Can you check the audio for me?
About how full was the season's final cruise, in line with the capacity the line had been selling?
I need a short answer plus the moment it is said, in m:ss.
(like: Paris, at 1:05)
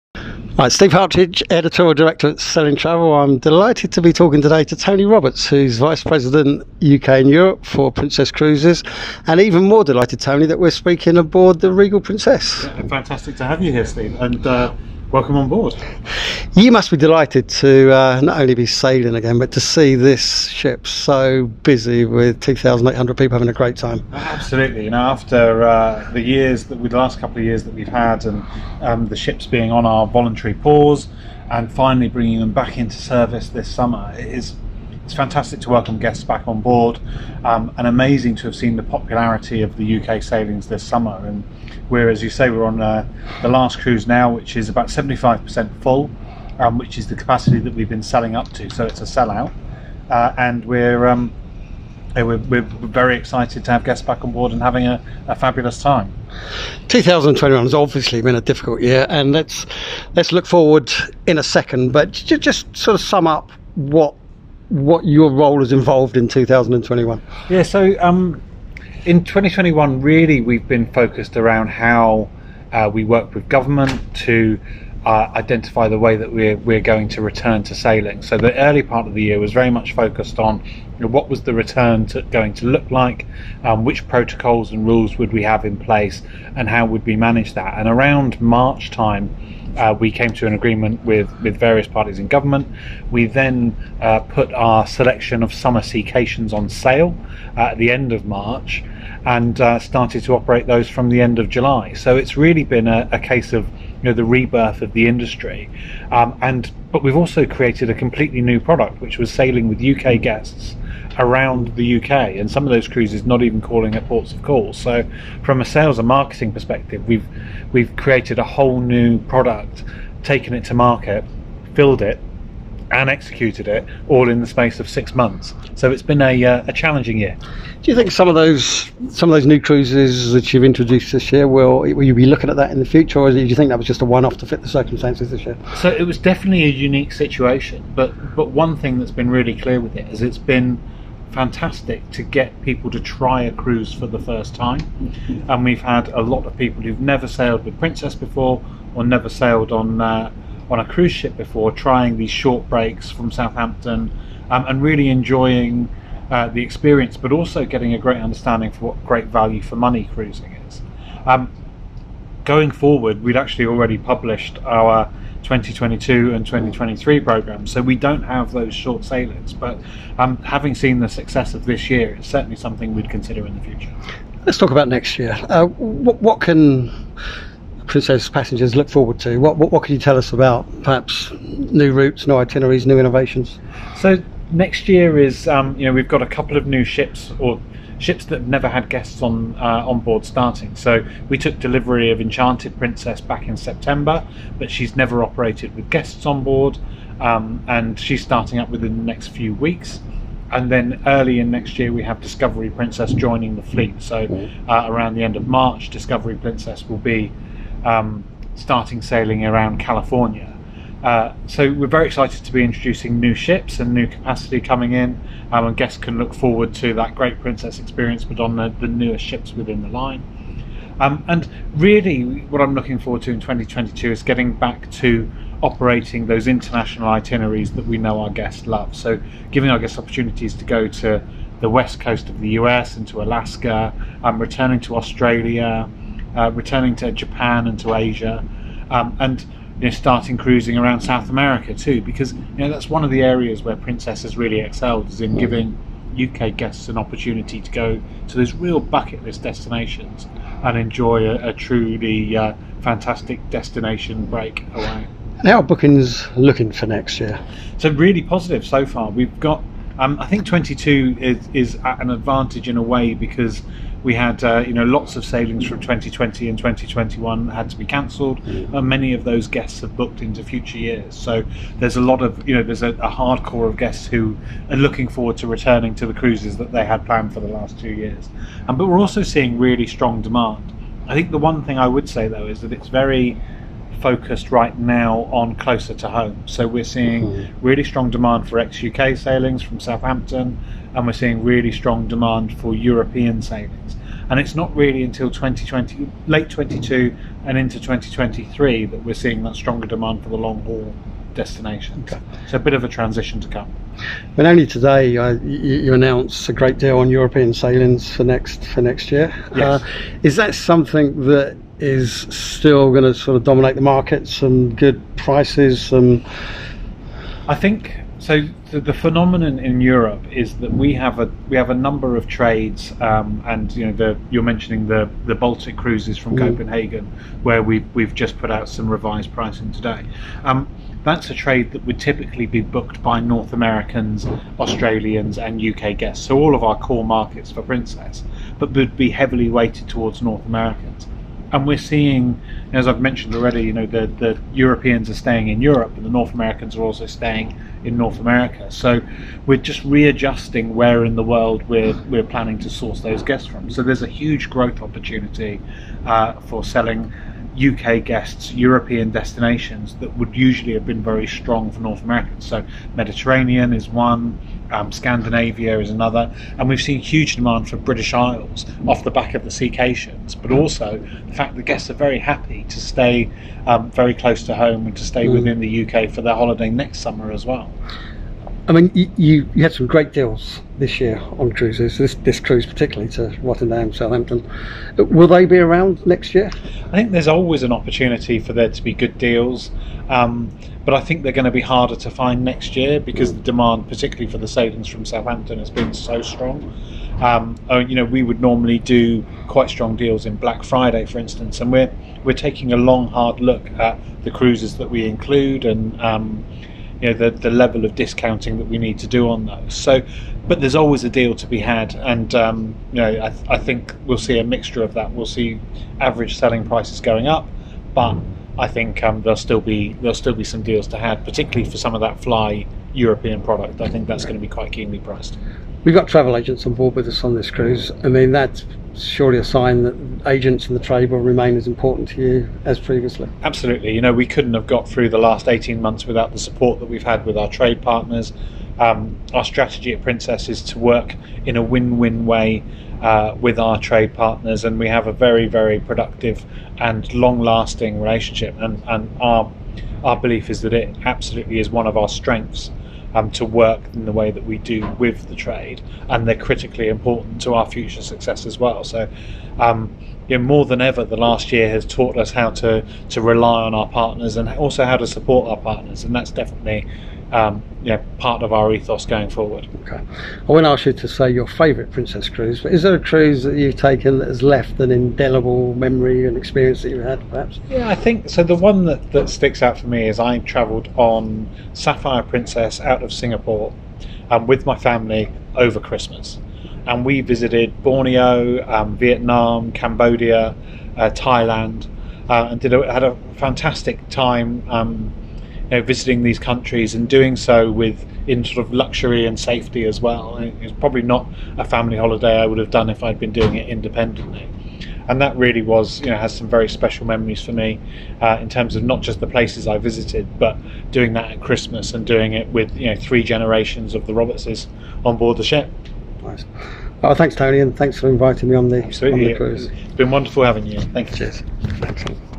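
75%, at 0:44.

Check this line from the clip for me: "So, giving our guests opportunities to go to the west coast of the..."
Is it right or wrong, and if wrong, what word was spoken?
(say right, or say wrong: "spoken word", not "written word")
right.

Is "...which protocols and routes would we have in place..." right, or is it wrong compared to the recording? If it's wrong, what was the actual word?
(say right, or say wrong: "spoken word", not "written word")
wrong: "rules", not "routes".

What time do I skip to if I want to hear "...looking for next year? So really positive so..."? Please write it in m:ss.
4:16.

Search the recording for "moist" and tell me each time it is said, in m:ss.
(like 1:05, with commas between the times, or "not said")
not said.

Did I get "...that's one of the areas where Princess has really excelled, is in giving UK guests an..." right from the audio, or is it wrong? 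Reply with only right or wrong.
right.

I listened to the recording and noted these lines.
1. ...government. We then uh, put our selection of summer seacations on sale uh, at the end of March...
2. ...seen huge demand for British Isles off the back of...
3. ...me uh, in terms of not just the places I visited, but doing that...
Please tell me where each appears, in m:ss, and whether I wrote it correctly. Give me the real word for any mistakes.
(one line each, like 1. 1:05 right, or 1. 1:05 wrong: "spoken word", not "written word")
1. 1:32 right
2. 6:06 right
3. 8:27 right.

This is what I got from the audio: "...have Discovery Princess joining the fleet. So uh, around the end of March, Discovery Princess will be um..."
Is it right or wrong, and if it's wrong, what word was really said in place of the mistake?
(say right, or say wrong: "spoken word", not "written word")
right.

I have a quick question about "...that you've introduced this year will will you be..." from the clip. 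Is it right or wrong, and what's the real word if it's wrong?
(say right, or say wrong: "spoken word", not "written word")
right.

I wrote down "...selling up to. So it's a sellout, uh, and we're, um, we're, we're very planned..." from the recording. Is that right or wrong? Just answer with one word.
wrong.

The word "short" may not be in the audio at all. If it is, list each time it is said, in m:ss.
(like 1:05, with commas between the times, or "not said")
2:32, 2:48.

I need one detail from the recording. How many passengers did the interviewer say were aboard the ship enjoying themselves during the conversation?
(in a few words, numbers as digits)
2,800.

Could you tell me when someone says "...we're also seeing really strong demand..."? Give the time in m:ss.
4:38.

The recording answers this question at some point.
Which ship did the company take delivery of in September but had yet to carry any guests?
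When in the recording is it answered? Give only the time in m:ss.
3:12.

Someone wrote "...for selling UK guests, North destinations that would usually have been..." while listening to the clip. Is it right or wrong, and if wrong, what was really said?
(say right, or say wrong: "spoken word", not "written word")
wrong: "European", not "North".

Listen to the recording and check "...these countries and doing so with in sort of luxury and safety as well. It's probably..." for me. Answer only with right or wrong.
right.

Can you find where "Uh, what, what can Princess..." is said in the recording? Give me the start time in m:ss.
2:55.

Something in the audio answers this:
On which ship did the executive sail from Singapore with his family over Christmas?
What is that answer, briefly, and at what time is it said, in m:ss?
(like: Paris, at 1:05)
Sapphire Princess, at 8:01.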